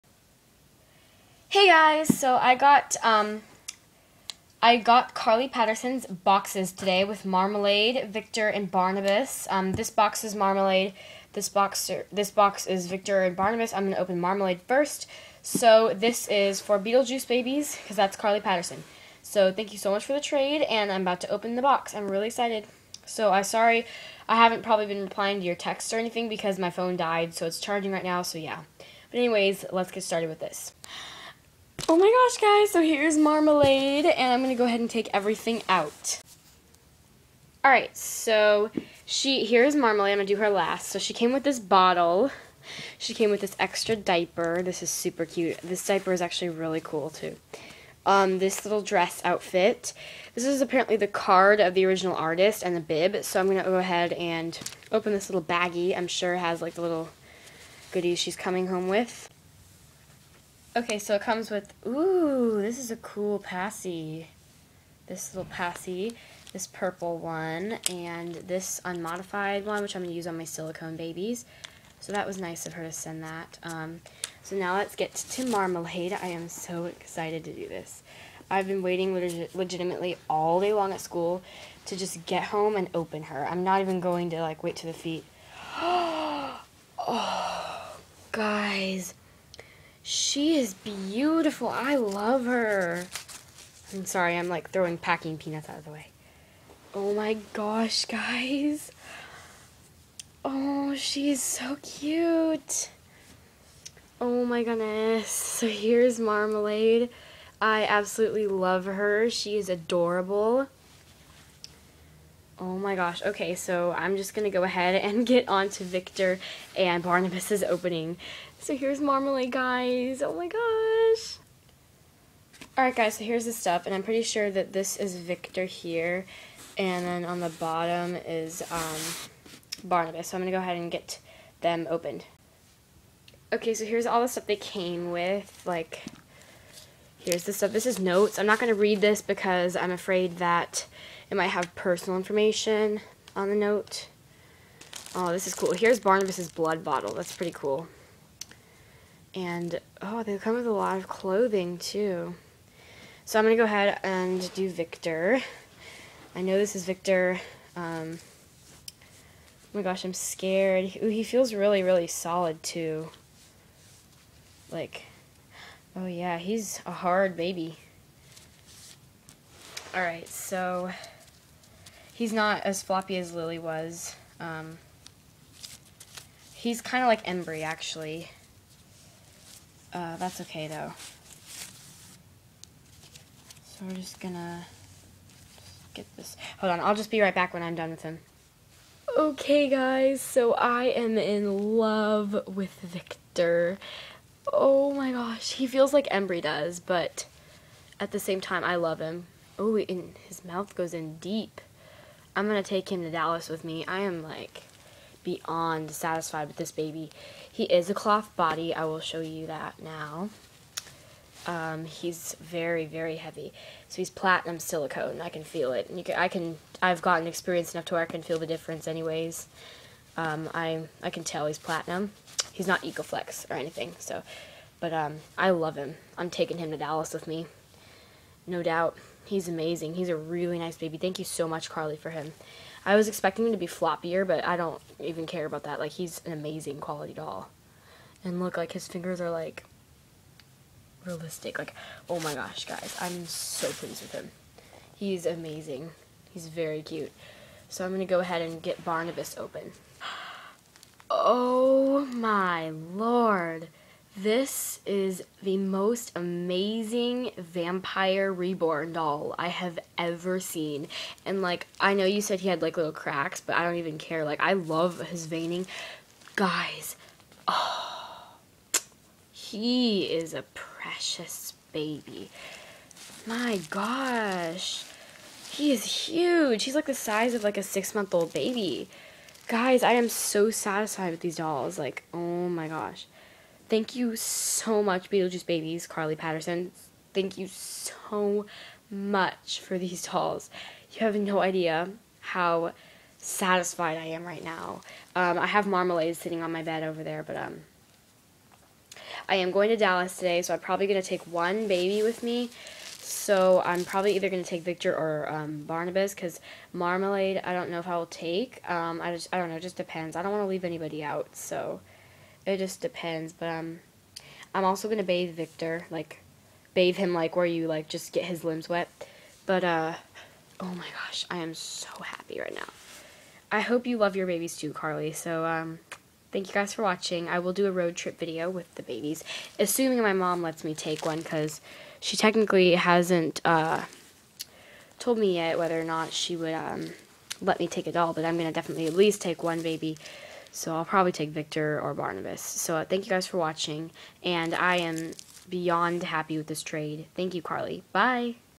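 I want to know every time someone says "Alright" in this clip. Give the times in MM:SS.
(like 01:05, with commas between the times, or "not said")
00:37, 02:02, 02:49.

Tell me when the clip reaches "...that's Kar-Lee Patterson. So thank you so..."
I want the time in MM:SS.
00:17.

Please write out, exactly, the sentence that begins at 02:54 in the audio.
Um, he's kind of like Embry, actually.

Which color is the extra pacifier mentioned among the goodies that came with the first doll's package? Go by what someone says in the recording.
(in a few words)
Purple.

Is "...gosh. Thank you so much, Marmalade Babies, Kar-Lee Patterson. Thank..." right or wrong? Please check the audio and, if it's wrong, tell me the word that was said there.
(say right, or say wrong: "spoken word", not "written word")
wrong: "Beetlejuice", not "Marmalade".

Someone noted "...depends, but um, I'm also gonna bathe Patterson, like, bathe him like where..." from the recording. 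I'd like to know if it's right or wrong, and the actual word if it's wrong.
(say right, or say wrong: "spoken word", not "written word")
wrong: "Viktor", not "Patterson".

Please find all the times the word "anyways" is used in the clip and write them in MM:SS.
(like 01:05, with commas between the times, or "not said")
00:29, 03:38.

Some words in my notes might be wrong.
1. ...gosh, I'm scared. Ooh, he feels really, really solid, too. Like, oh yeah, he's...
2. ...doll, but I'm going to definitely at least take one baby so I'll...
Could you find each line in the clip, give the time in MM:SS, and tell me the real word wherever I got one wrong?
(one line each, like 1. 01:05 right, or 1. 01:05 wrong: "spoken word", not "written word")
1. 02:39 right
2. 05:37 right.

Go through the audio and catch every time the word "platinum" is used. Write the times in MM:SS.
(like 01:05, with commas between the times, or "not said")
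03:34, 03:41.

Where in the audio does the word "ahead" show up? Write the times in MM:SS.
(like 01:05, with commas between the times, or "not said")
00:34, 00:53, 01:54, 02:10, 02:33, 04:08.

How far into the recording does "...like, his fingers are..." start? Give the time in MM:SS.
03:58.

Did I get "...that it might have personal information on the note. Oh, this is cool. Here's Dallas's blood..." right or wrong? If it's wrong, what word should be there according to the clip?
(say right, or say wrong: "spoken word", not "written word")
wrong: "Barnabus", not "Dallas".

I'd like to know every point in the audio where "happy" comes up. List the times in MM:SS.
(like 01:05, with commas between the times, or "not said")
05:22, 05:46.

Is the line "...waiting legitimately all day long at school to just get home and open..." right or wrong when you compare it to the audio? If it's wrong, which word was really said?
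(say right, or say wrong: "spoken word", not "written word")
right.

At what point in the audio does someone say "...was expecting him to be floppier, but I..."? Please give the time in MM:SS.
03:52.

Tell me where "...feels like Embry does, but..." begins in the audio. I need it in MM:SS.
03:15.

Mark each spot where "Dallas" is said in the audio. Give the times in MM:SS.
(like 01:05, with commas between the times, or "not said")
03:23, 03:46, 04:59.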